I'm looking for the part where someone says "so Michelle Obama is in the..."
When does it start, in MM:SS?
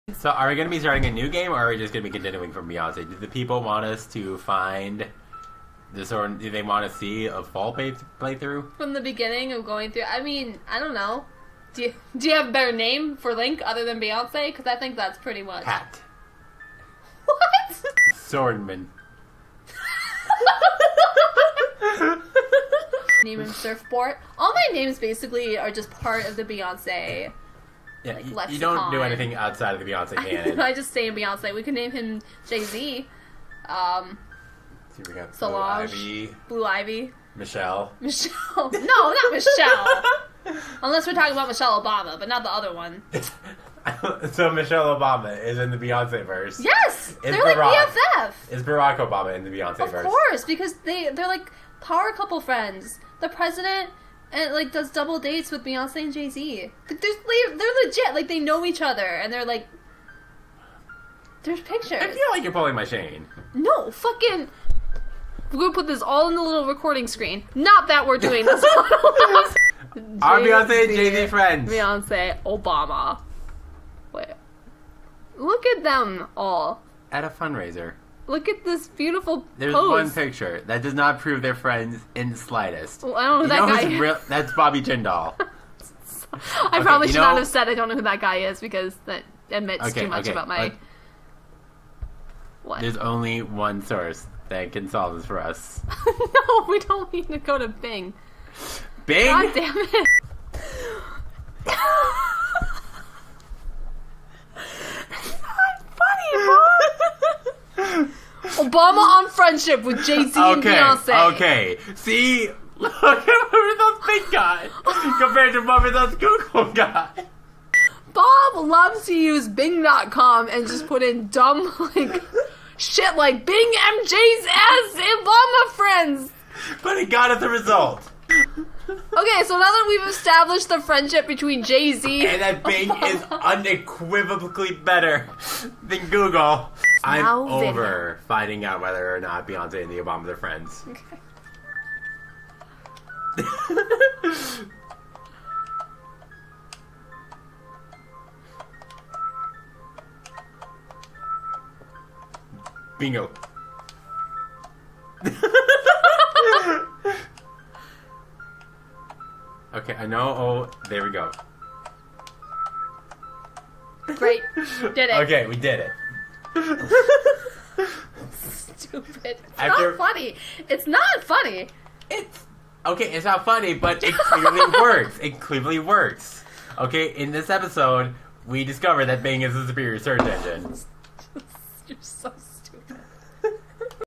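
00:44.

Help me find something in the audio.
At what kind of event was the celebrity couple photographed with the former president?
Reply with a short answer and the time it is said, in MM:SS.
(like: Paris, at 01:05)
A fundraiser, at 01:17.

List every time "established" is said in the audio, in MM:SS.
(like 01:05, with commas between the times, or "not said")
02:10.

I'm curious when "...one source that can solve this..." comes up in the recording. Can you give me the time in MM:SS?
01:33.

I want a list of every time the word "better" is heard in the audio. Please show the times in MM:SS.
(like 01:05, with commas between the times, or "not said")
00:12, 02:14.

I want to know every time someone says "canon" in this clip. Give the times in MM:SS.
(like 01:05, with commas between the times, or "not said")
00:30.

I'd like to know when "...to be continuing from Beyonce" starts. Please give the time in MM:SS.
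00:02.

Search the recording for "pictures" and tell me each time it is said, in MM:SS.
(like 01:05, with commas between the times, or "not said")
01:01, 01:20.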